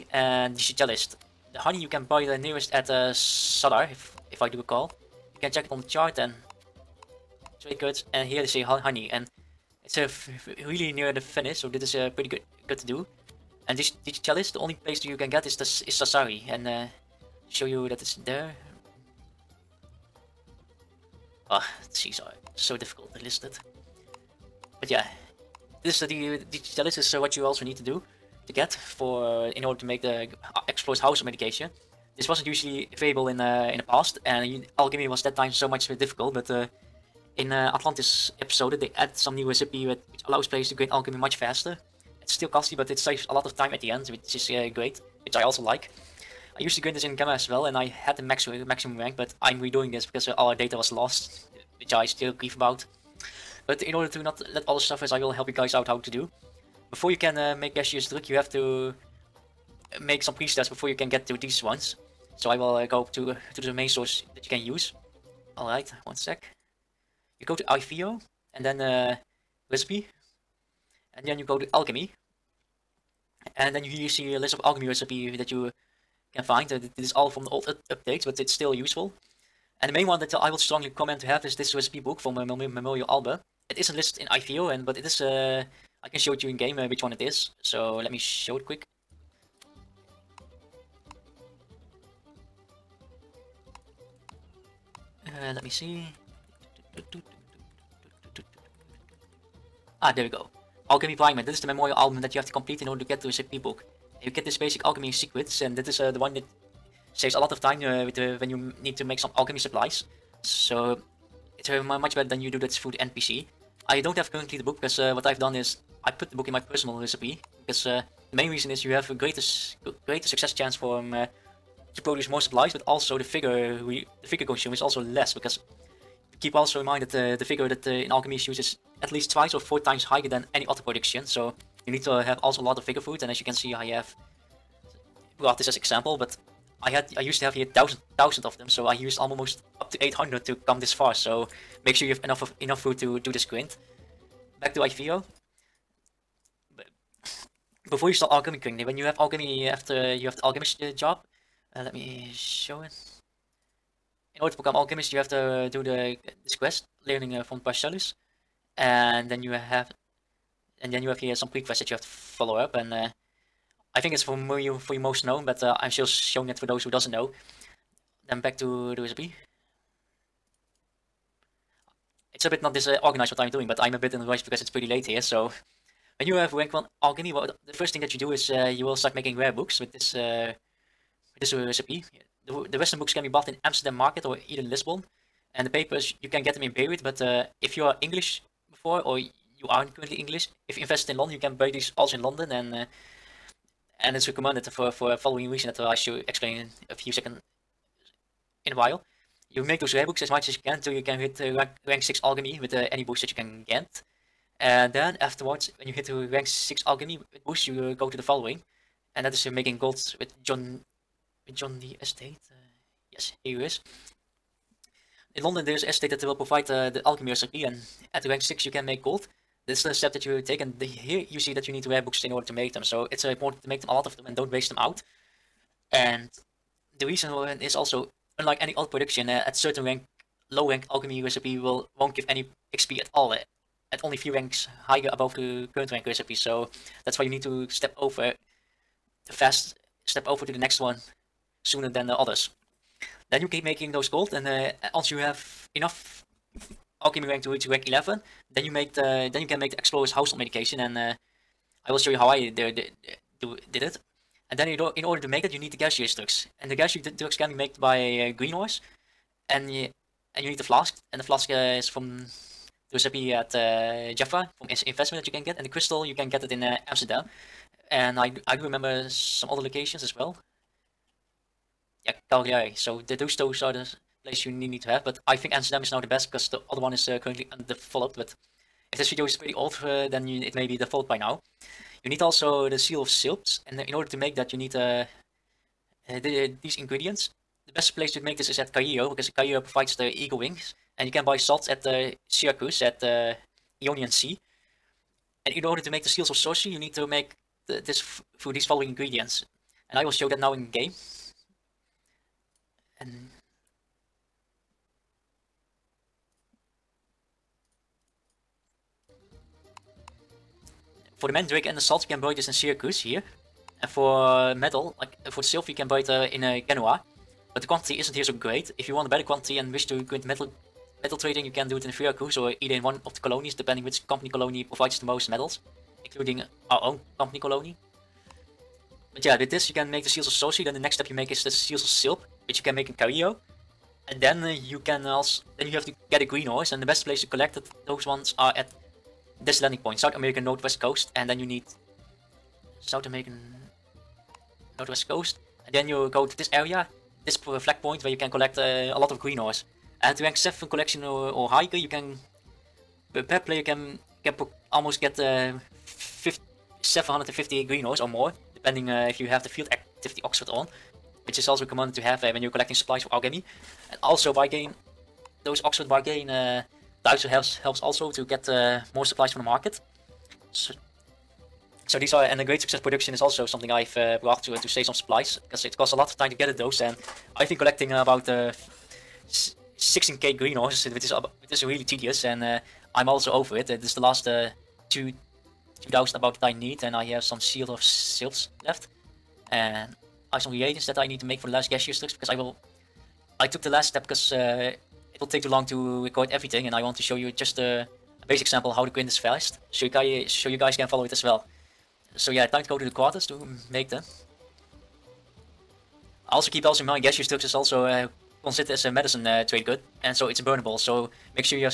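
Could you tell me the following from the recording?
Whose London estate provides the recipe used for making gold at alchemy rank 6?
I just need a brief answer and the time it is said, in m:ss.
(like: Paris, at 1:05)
John Dee, at 3:31.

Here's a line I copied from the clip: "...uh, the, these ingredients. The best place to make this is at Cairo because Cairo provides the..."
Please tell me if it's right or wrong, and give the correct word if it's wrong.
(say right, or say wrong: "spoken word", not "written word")
right.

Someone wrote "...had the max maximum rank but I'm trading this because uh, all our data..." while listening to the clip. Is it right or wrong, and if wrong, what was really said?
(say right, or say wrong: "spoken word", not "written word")
wrong: "redoing", not "trading".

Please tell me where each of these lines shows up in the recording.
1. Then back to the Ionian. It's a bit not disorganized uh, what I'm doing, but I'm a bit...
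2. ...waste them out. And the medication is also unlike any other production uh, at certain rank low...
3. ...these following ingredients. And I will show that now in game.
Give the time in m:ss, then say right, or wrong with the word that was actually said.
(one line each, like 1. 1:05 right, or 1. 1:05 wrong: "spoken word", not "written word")
1. 2:48 wrong: "USB", not "Ionian"
2. 3:44 wrong: "reason", not "medication"
3. 4:58 right.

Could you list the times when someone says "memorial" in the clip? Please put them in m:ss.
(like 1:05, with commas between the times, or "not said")
1:22, 1:41.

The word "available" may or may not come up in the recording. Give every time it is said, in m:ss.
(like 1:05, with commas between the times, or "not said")
0:32.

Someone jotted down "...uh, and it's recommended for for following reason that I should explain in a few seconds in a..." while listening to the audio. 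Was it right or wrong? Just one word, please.
right.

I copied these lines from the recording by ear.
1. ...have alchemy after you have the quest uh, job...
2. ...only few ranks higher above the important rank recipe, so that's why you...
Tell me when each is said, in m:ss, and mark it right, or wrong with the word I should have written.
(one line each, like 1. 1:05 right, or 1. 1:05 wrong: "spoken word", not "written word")
1. 2:29 wrong: "alchemist", not "quest"
2. 3:54 wrong: "current", not "important".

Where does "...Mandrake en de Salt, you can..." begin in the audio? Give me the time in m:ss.
5:11.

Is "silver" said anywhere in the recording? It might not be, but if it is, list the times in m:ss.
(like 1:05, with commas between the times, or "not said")
5:15.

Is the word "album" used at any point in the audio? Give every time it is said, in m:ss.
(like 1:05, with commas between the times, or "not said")
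1:23, 1:41.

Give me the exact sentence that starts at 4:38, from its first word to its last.
But if this video is pretty old, uh, then you, it may be default by now.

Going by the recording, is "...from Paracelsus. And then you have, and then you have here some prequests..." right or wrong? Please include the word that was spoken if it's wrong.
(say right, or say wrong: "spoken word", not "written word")
right.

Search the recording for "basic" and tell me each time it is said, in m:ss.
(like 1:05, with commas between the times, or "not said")
1:44, 6:38.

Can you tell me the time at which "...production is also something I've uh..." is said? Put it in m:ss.
6:12.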